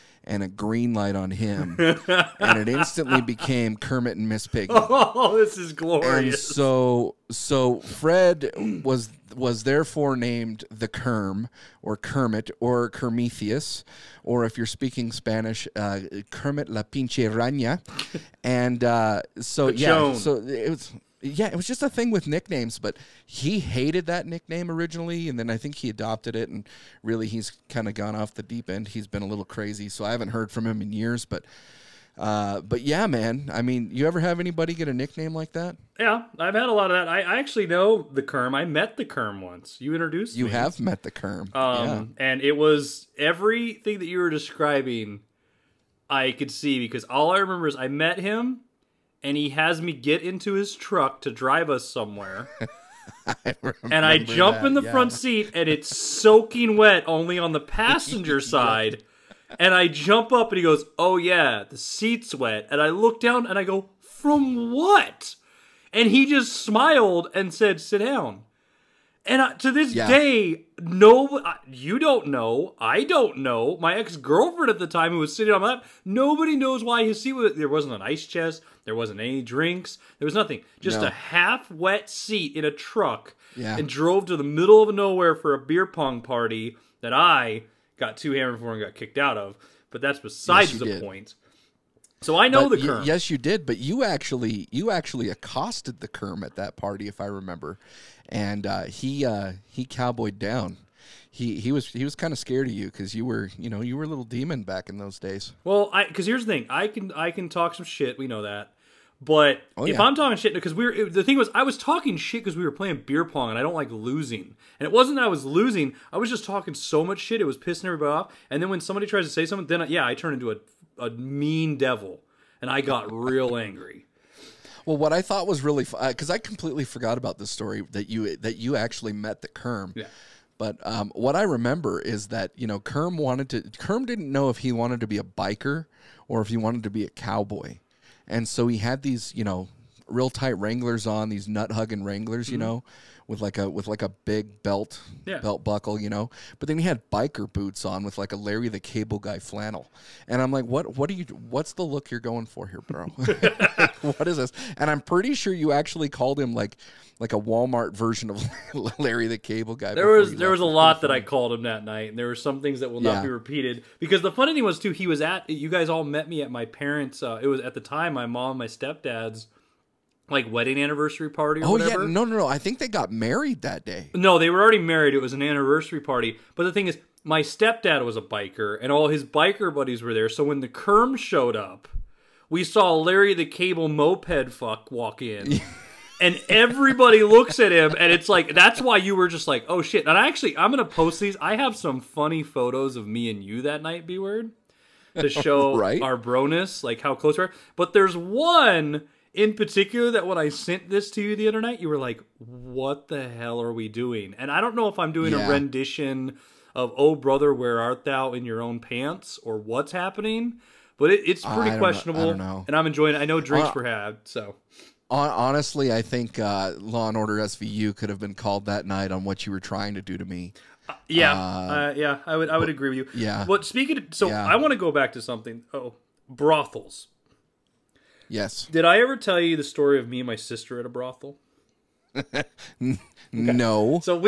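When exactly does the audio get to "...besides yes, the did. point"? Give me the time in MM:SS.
01:30.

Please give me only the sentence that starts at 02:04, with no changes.
Well, what I thought was really because uh, I completely forgot about this story that you that you actually met the Kerm.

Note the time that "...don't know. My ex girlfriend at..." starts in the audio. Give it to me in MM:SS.
01:13.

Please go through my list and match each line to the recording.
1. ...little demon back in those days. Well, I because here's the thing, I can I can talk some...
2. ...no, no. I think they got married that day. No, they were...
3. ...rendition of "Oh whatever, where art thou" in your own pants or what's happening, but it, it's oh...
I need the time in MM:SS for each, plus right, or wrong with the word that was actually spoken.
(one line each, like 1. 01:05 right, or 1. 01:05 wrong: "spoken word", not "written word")
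1. 01:44 right
2. 02:52 right
3. 03:25 wrong: "brother", not "whatever".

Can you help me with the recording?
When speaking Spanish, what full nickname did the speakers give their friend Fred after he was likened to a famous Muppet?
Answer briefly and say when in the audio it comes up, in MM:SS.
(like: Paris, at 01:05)
Kermit la pinche raña, at 00:16.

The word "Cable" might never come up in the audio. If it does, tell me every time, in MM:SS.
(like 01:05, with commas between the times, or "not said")
02:28, 02:39, 03:03.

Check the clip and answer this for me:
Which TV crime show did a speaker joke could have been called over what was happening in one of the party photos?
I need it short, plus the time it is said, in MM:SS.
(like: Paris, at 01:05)
Law and Order SVU, at 03:36.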